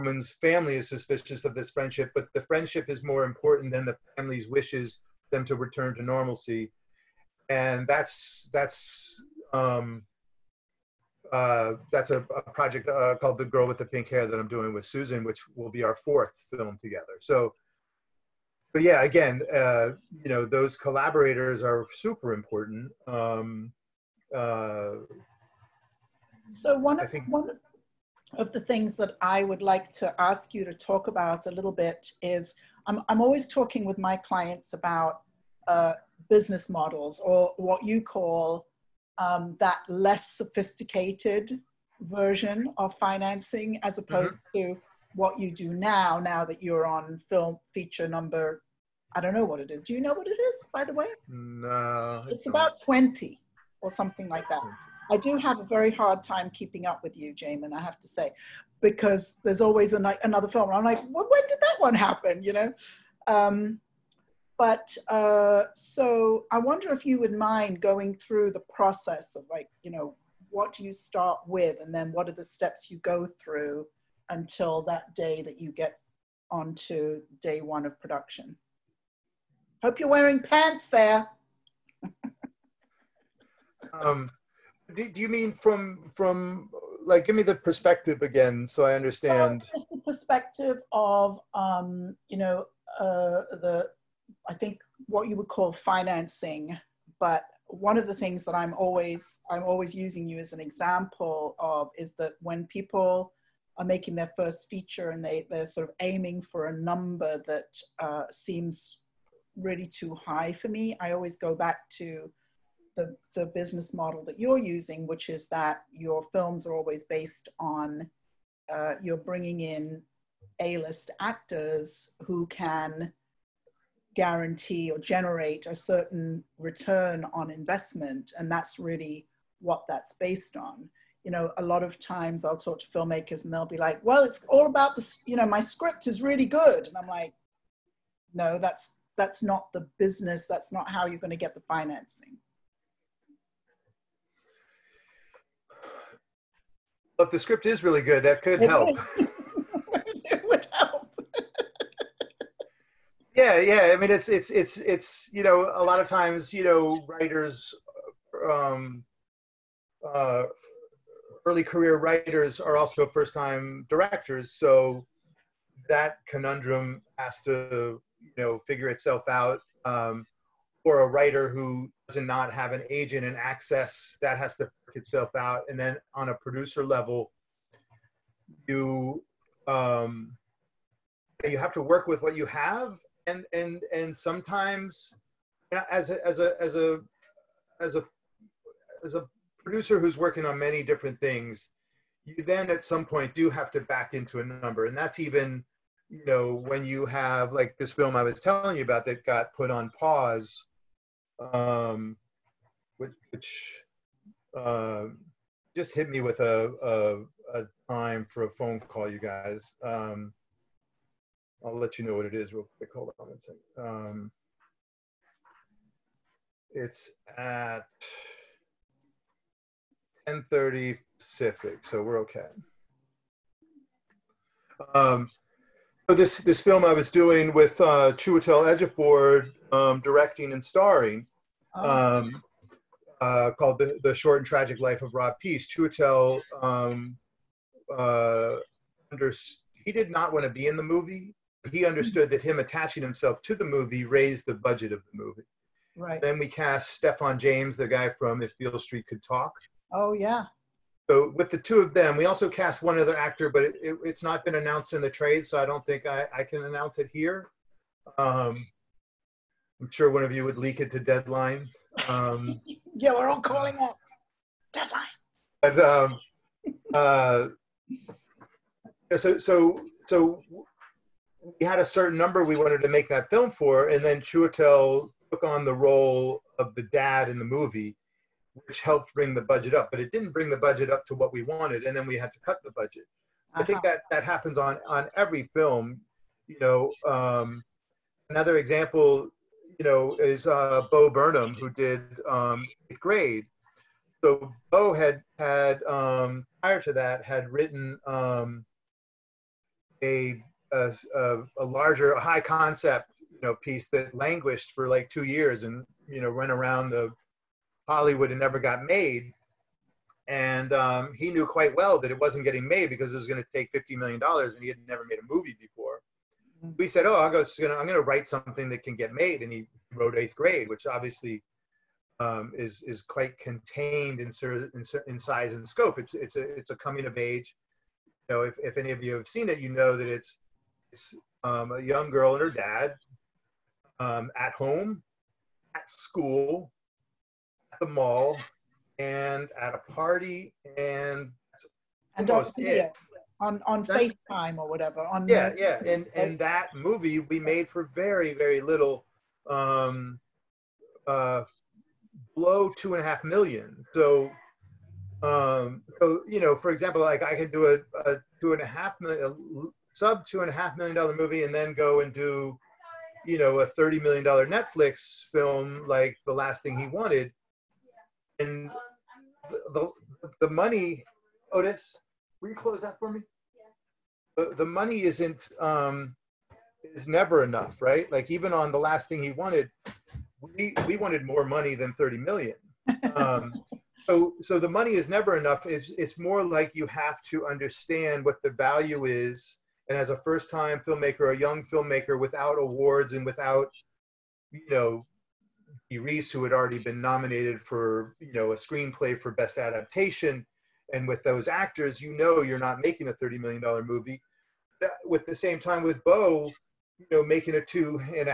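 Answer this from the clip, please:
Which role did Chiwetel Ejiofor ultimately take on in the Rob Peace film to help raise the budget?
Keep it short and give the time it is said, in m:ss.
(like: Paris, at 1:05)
the dad, at 4:36.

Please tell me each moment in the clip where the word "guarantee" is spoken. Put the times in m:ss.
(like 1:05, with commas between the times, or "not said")
2:04.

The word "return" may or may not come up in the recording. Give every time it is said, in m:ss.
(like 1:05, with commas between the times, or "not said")
0:05, 2:06.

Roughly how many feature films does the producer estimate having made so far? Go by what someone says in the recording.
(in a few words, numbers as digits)
20.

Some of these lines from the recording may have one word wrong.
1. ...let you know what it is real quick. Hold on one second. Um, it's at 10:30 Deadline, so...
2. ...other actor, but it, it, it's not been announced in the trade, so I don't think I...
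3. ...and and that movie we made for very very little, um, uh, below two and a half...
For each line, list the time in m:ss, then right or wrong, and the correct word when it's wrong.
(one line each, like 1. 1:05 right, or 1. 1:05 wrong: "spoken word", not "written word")
1. 3:31 wrong: "Pacific", not "Deadline"
2. 4:12 right
3. 5:45 right.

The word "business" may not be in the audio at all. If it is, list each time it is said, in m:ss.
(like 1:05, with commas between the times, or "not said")
0:36, 1:53, 2:19.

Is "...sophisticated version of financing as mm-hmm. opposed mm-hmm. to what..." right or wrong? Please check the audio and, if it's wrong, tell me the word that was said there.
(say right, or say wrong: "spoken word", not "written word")
right.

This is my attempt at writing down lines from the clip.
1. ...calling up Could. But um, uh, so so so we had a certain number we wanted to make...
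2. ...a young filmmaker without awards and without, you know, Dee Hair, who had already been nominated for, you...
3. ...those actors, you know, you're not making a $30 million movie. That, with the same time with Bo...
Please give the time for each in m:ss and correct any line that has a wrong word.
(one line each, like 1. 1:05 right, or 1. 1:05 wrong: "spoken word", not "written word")
1. 4:23 wrong: "Deadline", not "Could"
2. 6:31 wrong: "Rees", not "Hair"
3. 6:41 right.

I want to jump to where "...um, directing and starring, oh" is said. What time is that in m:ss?
3:49.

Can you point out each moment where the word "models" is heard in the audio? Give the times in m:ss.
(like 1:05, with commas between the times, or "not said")
0:36, 1:53.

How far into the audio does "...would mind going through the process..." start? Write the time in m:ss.
1:07.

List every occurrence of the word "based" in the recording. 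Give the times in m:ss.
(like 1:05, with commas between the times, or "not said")
1:57, 2:10.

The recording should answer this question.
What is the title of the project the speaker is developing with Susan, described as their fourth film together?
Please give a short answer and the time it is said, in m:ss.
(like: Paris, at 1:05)
The Girl with the Pink Hair, at 0:13.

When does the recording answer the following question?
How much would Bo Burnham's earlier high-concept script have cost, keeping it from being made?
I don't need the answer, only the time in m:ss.
5:13.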